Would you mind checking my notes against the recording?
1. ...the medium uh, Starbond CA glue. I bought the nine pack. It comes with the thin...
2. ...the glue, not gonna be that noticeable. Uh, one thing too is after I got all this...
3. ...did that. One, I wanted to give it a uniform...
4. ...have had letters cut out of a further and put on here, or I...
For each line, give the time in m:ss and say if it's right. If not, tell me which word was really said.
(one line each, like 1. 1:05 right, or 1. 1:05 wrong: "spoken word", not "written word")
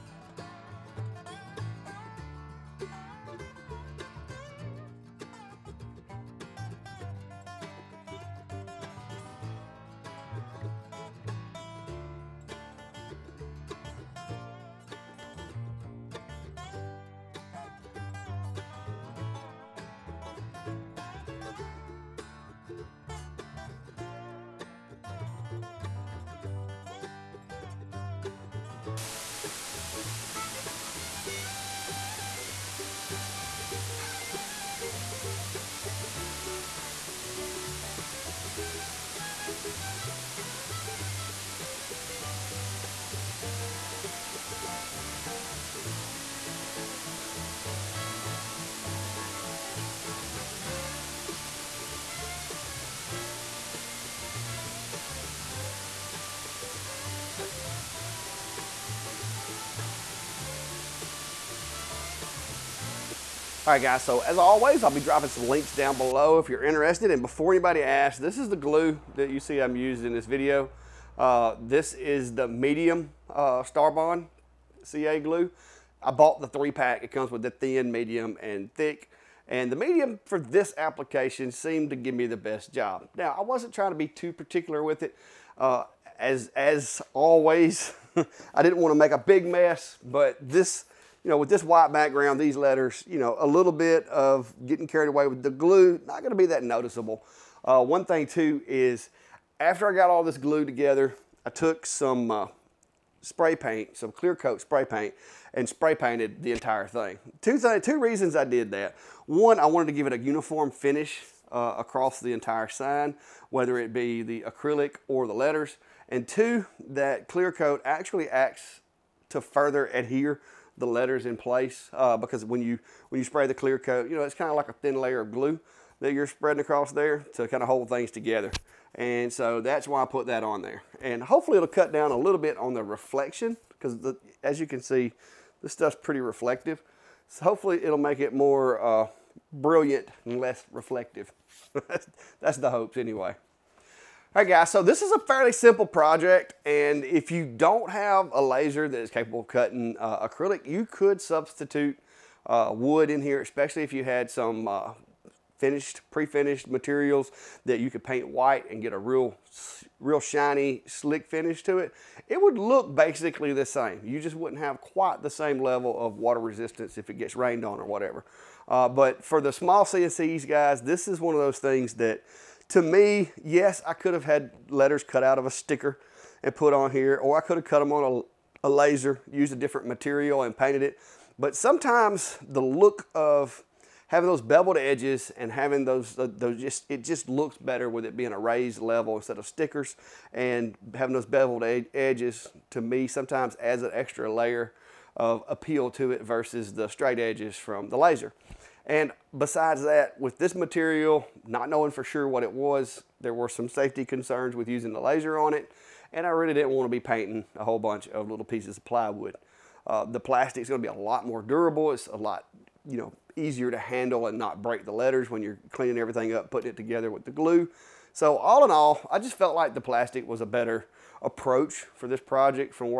1. 1:12 wrong: "three", not "nine"
2. 1:35 right
3. 1:48 right
4. 2:54 wrong: "sticker", not "further".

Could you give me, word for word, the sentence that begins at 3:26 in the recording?
And I really didn't want to be painting a whole bunch of little pieces of plywood.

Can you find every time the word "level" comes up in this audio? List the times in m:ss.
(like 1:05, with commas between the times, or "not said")
2:45, 3:08.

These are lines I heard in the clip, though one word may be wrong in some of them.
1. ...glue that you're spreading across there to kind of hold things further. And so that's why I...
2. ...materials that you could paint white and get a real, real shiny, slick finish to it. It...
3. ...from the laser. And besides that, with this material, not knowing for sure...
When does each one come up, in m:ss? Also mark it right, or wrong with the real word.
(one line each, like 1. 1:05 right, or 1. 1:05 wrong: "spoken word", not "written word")
1. 2:05 wrong: "together", not "further"
2. 2:36 right
3. 3:17 right.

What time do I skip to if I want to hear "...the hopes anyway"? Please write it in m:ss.
2:22.